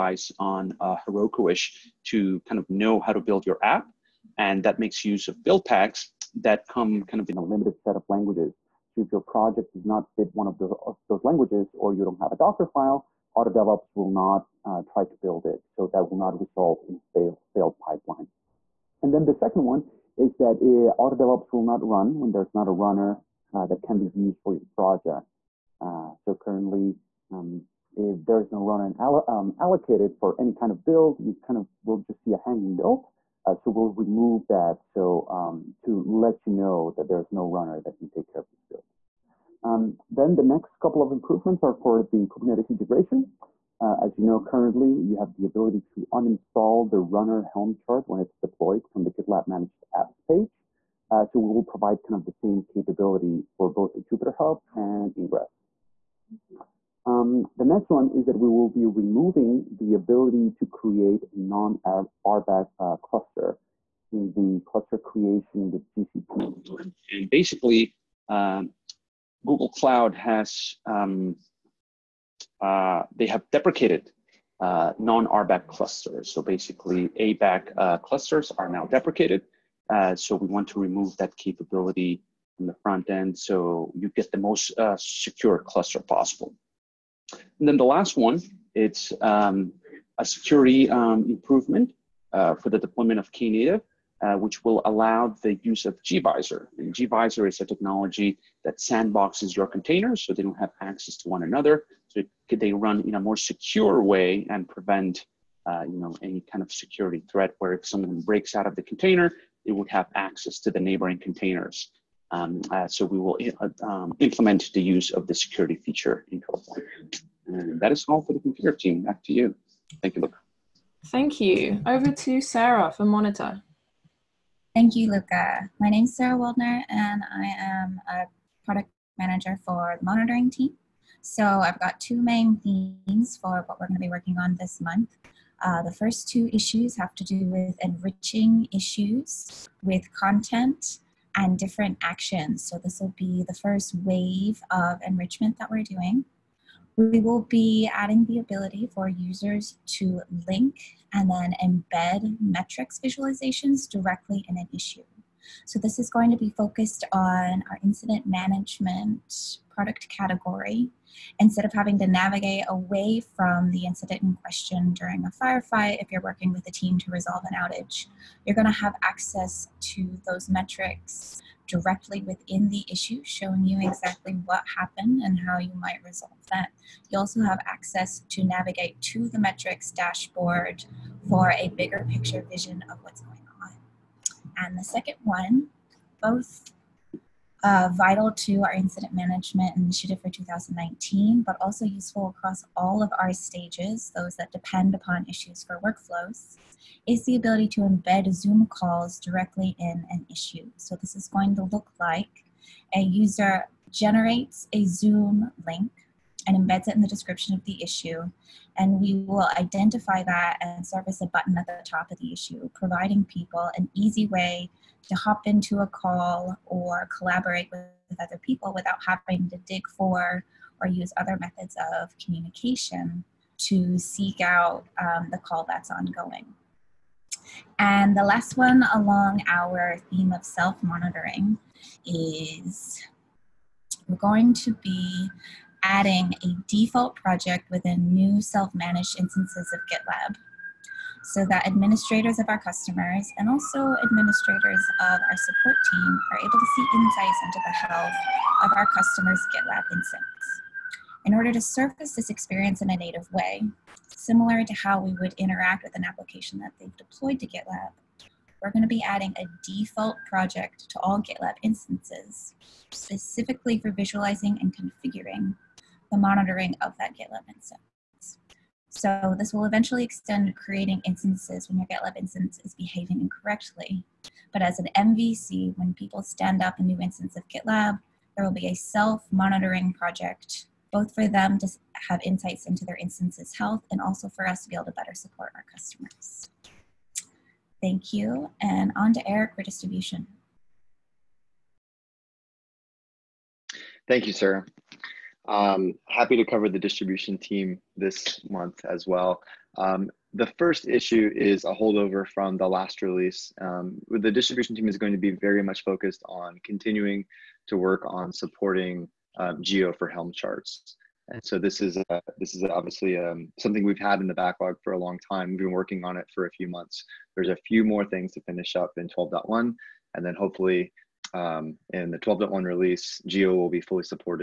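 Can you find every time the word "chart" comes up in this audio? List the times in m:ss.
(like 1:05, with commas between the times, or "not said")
0:47, 5:10.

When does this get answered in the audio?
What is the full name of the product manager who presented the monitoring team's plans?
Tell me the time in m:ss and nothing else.
2:06.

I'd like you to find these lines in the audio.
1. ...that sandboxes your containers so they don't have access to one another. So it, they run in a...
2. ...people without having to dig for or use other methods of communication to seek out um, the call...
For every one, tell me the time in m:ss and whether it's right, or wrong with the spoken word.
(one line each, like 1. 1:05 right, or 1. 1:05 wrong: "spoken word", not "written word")
1. 1:38 right
2. 3:38 right.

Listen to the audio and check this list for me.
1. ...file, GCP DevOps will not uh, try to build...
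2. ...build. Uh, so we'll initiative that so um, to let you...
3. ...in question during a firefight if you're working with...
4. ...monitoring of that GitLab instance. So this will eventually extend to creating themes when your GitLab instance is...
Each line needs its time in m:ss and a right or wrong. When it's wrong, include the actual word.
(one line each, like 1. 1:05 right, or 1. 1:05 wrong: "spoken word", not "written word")
1. 0:12 wrong: "Auto", not "GCP"
2. 0:32 wrong: "remove", not "initiative"
3. 2:44 right
4. 4:26 wrong: "instances", not "themes".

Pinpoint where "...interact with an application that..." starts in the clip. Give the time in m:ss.
4:15.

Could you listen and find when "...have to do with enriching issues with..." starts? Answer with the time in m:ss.
2:16.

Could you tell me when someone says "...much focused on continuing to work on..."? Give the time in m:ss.
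5:05.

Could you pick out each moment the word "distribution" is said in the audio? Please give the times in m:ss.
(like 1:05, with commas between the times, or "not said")
4:49, 4:56, 5:04.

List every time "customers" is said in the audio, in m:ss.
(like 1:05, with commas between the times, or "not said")
4:02, 4:08, 4:45.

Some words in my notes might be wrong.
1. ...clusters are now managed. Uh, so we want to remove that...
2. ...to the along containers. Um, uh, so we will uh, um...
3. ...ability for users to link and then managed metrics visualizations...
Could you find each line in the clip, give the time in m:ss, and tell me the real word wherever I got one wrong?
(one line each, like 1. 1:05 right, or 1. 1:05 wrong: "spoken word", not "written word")
1. 1:17 wrong: "deprecated", not "managed"
2. 1:50 wrong: "neighboring", not "along"
3. 2:28 wrong: "embed", not "managed".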